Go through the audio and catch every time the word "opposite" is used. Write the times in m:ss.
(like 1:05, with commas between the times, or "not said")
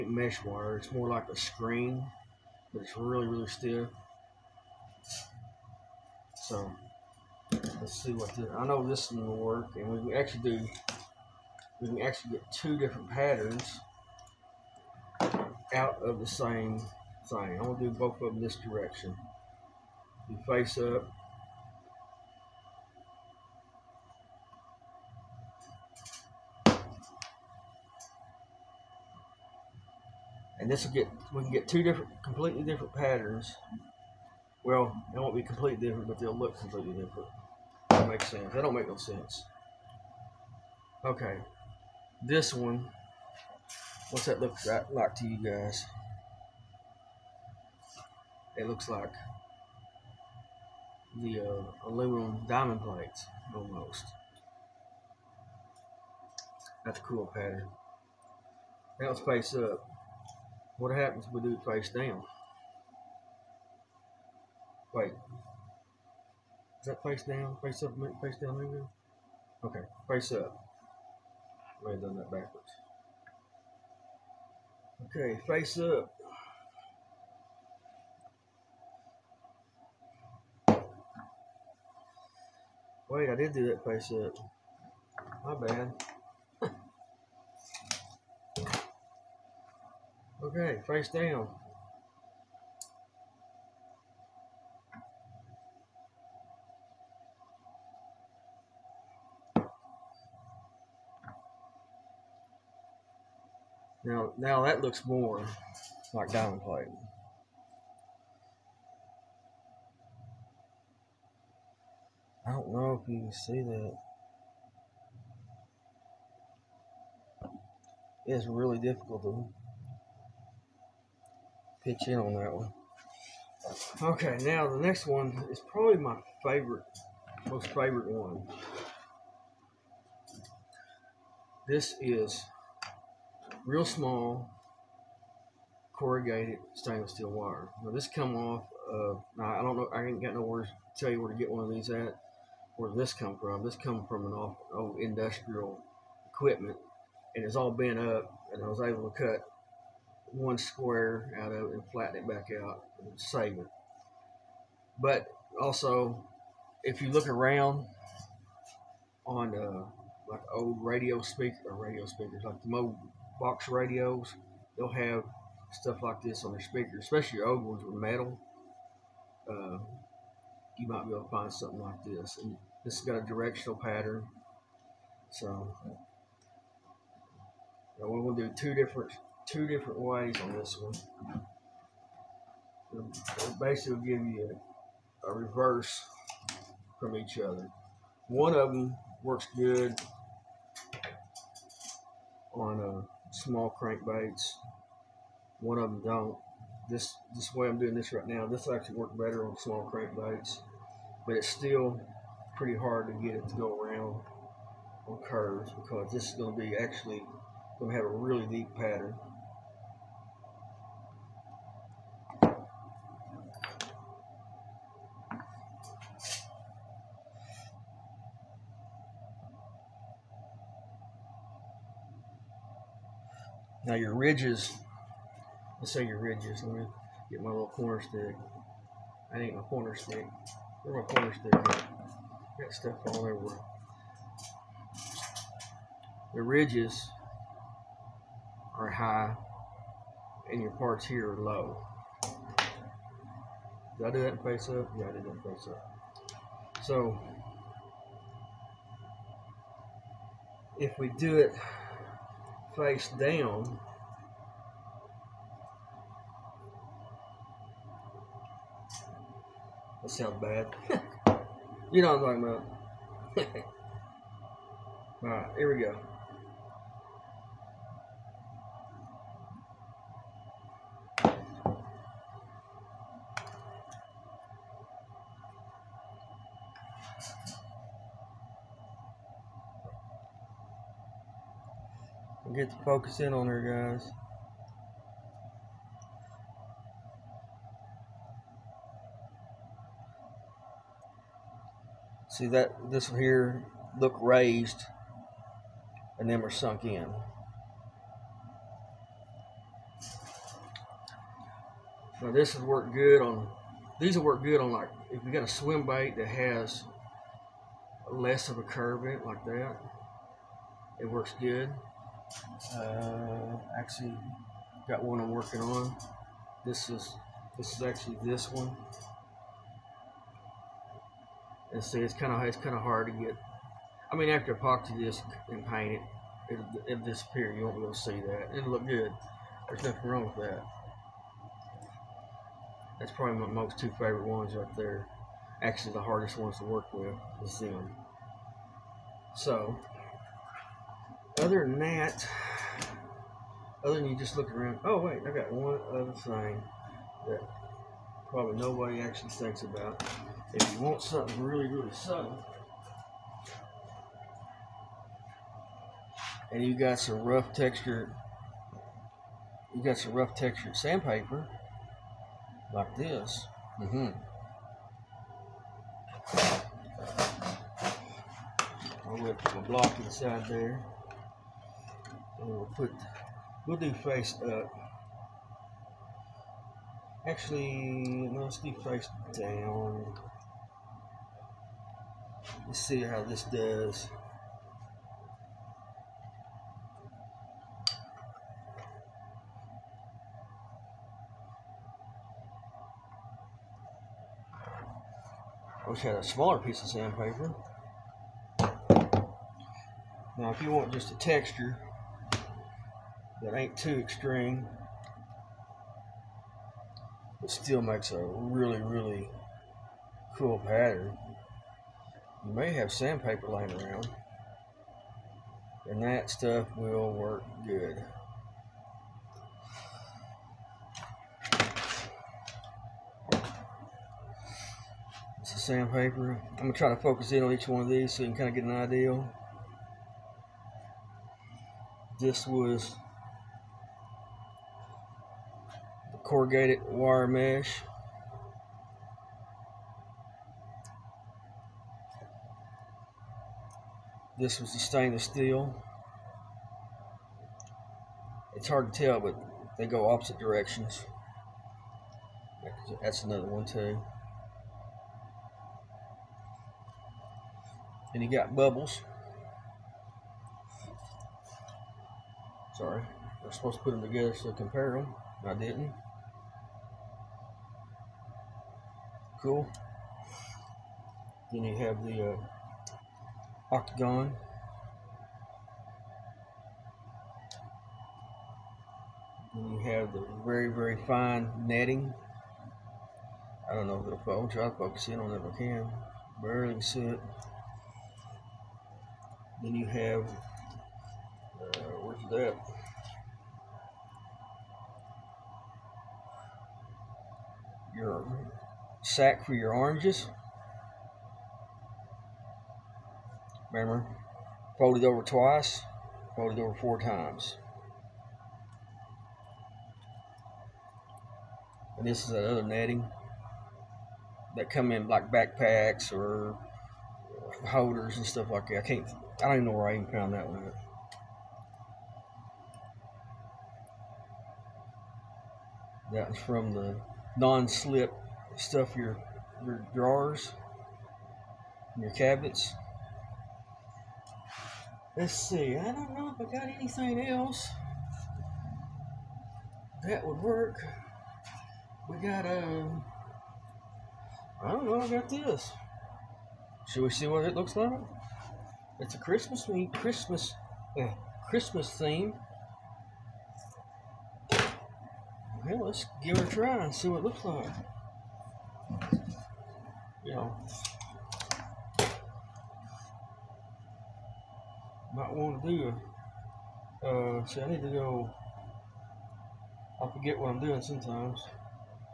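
7:30.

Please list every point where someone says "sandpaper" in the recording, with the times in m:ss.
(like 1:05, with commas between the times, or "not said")
6:00, 6:36, 6:52, 7:05.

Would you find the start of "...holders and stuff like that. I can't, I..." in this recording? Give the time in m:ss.
8:37.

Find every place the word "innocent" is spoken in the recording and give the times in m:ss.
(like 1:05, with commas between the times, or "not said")
not said.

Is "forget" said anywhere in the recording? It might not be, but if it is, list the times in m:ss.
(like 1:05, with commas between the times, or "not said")
9:30.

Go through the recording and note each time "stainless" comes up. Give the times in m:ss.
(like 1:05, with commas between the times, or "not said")
2:16, 7:24.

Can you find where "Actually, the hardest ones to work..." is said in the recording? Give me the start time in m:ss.
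5:35.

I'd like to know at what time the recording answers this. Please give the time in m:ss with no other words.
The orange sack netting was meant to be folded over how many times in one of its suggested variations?
8:26.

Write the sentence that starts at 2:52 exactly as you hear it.
And this has got a directional pattern.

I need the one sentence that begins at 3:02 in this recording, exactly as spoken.
It'll basically give you a, a reverse from each other.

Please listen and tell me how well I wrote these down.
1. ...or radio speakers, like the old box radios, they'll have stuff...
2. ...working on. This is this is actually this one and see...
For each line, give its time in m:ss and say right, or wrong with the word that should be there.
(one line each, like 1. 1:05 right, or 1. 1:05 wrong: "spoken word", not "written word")
1. 2:41 right
2. 5:15 right.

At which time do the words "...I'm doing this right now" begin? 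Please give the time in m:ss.
3:17.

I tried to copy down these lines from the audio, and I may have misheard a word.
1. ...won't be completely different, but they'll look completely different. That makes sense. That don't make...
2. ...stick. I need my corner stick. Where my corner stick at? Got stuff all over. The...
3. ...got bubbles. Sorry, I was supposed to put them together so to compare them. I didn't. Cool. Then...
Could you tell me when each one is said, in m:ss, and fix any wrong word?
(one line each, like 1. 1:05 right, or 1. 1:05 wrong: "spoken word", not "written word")
1. 0:35 right
2. 3:48 right
3. 7:38 right.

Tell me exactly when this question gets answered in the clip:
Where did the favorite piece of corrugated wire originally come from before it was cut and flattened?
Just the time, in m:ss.
2:24.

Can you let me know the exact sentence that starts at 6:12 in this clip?
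And we'll put, we'll do face up.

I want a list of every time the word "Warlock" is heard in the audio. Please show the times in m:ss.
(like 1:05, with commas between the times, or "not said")
not said.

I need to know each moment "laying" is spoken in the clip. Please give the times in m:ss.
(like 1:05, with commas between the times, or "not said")
6:53.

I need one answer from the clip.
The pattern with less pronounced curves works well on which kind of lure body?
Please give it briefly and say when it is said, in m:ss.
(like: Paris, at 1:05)
swim bait, at 5:05.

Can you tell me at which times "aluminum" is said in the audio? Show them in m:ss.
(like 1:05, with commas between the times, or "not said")
0:51.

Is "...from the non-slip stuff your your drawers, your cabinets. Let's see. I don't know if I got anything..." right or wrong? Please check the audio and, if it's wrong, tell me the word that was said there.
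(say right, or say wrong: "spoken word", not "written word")
right.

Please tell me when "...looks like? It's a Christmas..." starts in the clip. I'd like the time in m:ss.
9:07.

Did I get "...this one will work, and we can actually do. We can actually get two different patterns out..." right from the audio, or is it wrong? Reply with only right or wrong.
right.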